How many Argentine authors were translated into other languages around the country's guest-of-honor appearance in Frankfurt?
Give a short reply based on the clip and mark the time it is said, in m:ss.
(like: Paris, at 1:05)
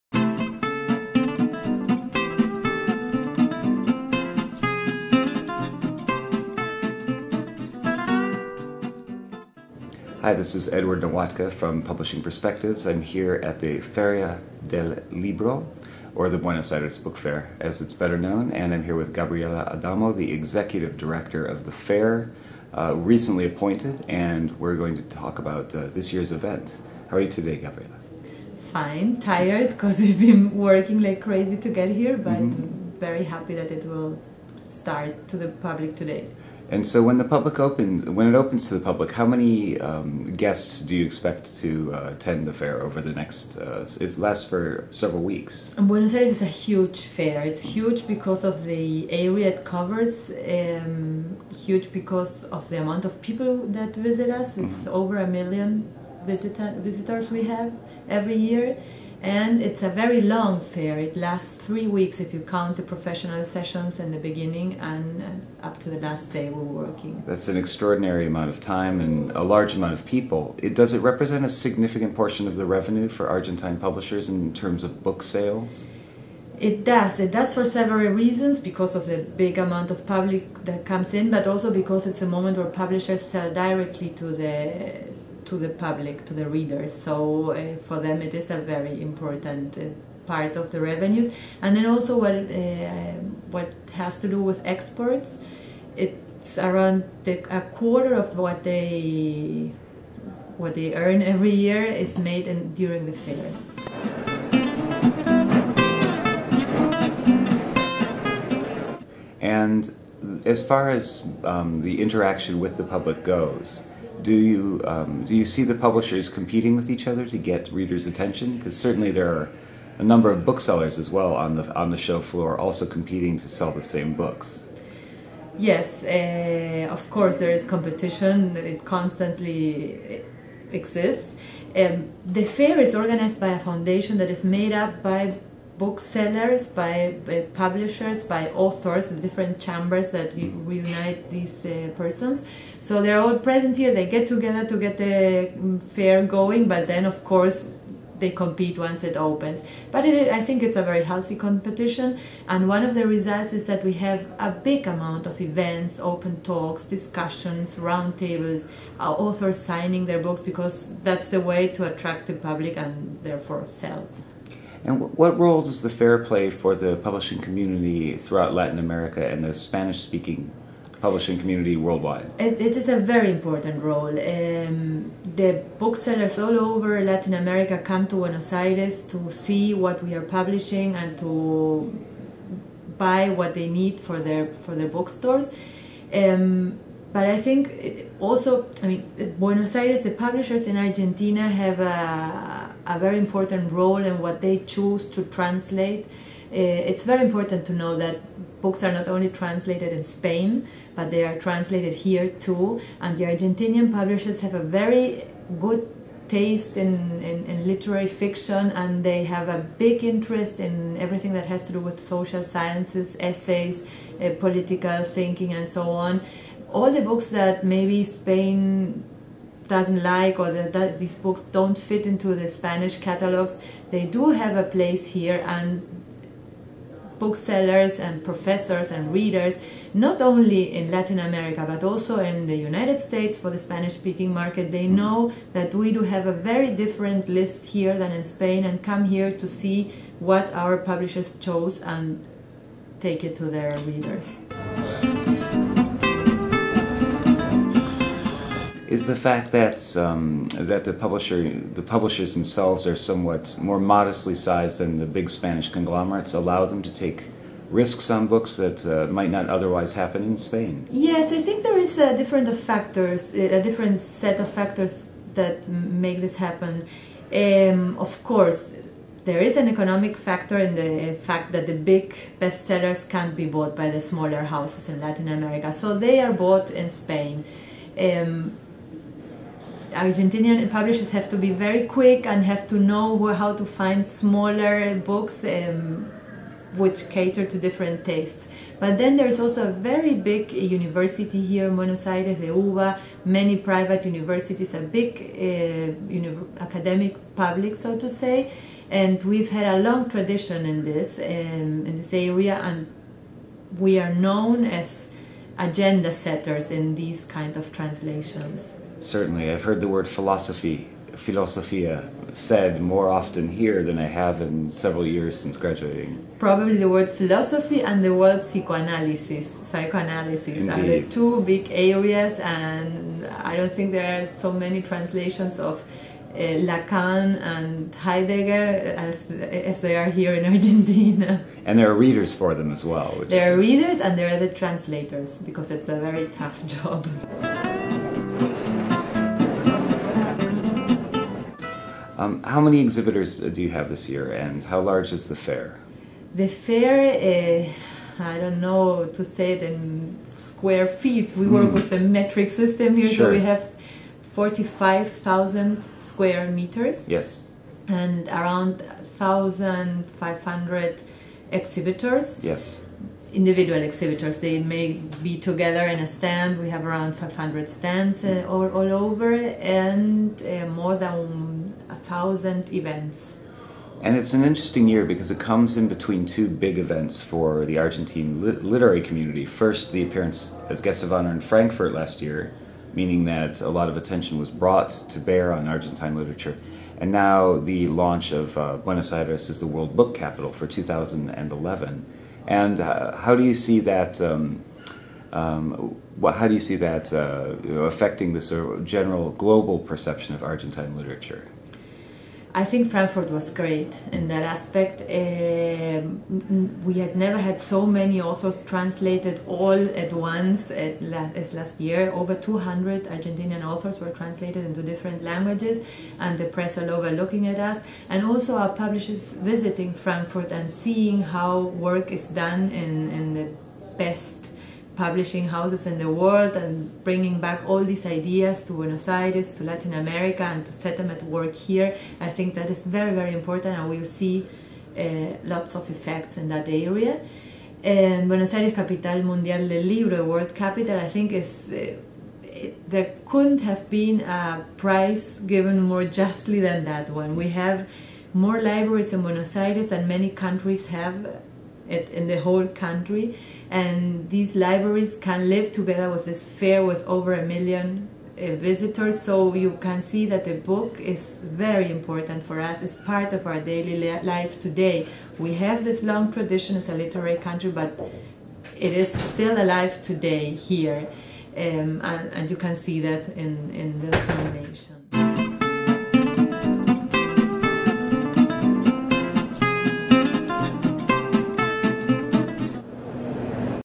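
Over 200, at 6:52.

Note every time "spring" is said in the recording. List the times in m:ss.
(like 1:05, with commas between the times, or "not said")
not said.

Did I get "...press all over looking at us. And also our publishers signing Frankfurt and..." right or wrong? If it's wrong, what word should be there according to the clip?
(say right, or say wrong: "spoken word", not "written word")
wrong: "visiting", not "signing".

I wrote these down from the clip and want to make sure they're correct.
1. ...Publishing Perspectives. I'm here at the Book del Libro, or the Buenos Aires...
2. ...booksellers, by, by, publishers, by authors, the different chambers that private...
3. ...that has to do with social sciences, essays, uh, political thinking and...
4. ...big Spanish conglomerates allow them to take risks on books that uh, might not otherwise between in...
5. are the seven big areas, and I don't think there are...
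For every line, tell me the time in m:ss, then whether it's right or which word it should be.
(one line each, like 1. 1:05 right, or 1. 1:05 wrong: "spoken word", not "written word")
1. 0:11 wrong: "Feria", not "Book"
2. 2:15 wrong: "reunite", not "private"
3. 3:31 right
4. 4:15 wrong: "happen", not "between"
5. 5:20 wrong: "two", not "seven".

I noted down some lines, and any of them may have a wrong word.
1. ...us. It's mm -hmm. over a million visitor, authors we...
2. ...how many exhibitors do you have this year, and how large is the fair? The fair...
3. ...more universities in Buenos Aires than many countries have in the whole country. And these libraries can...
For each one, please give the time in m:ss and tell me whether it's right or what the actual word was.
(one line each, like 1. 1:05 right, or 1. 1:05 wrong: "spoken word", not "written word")
1. 0:54 wrong: "visitors", not "authors"
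2. 5:42 right
3. 7:28 wrong: "libraries", not "universities".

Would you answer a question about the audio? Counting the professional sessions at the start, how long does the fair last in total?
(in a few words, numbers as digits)
3 weeks.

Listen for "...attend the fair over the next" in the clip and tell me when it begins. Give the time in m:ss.
0:42.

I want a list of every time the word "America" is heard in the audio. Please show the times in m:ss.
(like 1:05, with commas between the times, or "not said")
2:48, 2:57, 3:51, 4:35, 7:10.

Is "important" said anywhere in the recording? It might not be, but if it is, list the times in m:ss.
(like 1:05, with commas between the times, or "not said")
1:29, 2:53, 3:13, 3:17, 7:13, 7:41.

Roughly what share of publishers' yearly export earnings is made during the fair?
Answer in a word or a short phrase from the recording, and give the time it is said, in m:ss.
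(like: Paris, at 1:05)
A quarter, at 1:37.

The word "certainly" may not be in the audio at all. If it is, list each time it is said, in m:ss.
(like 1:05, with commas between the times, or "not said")
1:58, 5:09.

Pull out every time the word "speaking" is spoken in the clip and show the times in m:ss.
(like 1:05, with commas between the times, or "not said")
2:50, 3:53.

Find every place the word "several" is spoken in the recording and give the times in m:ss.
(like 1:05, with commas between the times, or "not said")
0:44, 1:17, 5:14.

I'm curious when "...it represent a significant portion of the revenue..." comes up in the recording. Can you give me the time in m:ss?
1:10.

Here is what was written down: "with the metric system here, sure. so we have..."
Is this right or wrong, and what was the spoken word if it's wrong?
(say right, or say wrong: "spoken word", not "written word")
right.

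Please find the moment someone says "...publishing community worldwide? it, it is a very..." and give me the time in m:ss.
2:51.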